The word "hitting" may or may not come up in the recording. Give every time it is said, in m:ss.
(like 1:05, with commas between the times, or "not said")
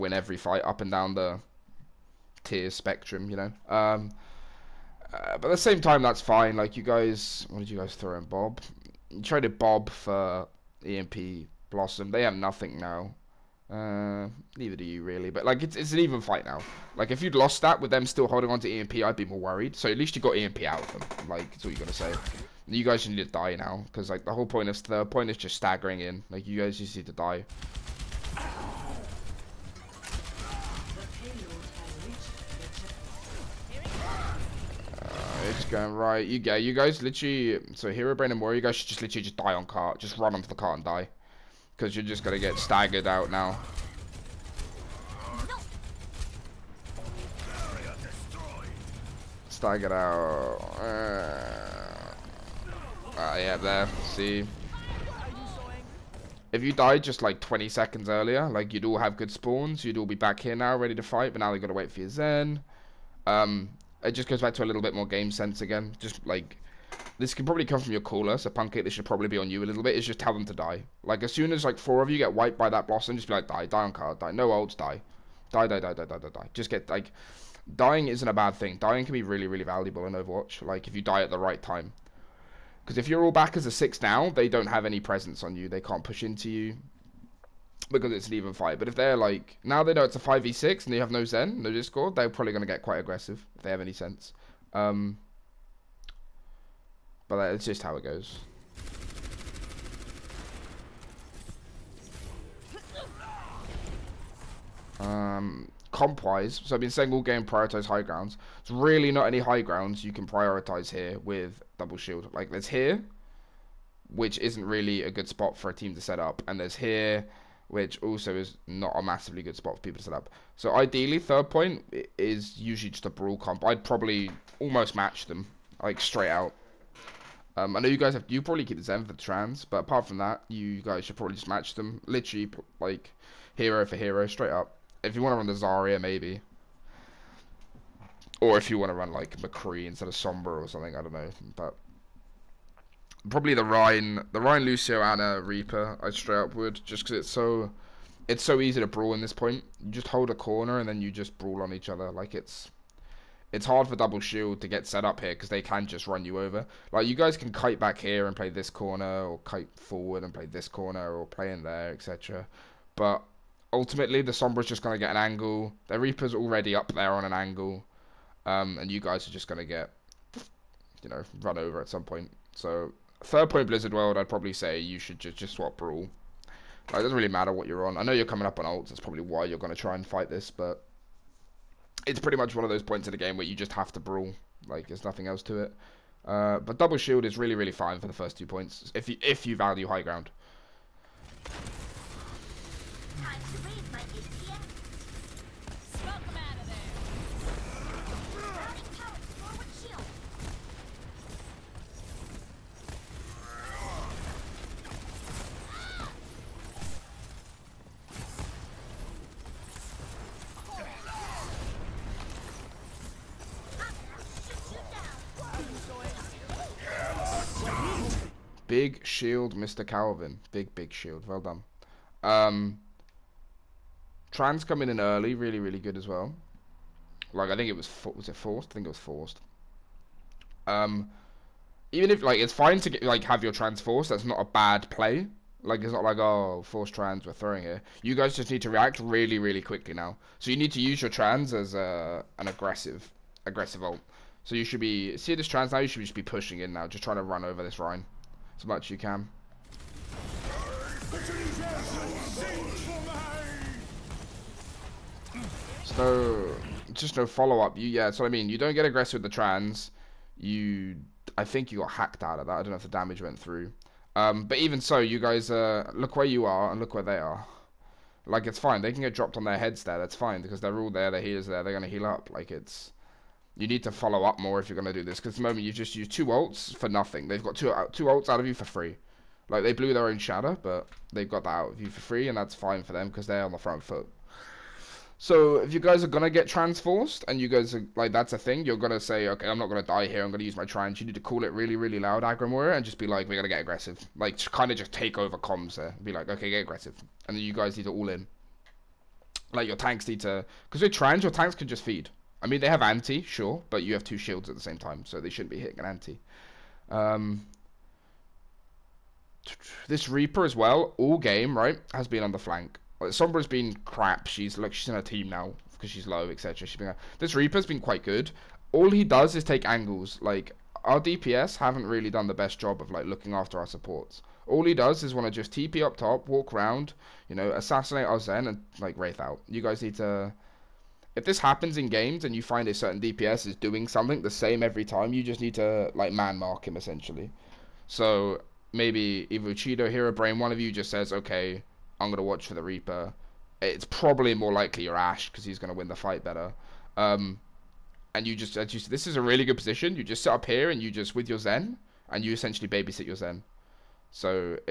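5:05.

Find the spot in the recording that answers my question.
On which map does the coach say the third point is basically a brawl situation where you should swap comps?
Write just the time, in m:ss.
2:53.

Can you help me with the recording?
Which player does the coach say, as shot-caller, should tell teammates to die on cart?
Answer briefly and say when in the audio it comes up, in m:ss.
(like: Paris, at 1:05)
Pancake, at 1:08.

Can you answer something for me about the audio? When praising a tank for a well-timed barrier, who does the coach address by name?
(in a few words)
Mr. Calvin.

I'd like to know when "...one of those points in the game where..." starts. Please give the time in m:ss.
3:02.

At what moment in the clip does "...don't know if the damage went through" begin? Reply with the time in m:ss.
4:22.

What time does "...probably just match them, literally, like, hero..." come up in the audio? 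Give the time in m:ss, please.
2:11.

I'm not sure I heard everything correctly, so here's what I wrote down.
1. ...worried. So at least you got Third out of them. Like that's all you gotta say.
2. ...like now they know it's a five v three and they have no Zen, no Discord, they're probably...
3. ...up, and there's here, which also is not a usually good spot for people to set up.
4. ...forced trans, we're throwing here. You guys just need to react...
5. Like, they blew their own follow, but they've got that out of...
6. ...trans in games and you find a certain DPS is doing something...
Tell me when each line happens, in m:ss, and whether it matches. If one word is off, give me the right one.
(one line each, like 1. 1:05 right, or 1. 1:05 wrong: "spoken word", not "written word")
1. 0:19 wrong: "EMP", not "Third"
2. 1:29 wrong: "six", not "three"
3. 1:56 wrong: "massively", not "usually"
4. 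3:56 right
5. 4:39 wrong: "shadow", not "follow"
6. 5:31 wrong: "happens", not "trans".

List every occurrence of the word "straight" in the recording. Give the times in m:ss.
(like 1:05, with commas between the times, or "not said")
2:05, 2:14, 2:26.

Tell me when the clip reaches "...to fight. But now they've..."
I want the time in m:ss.
1:00.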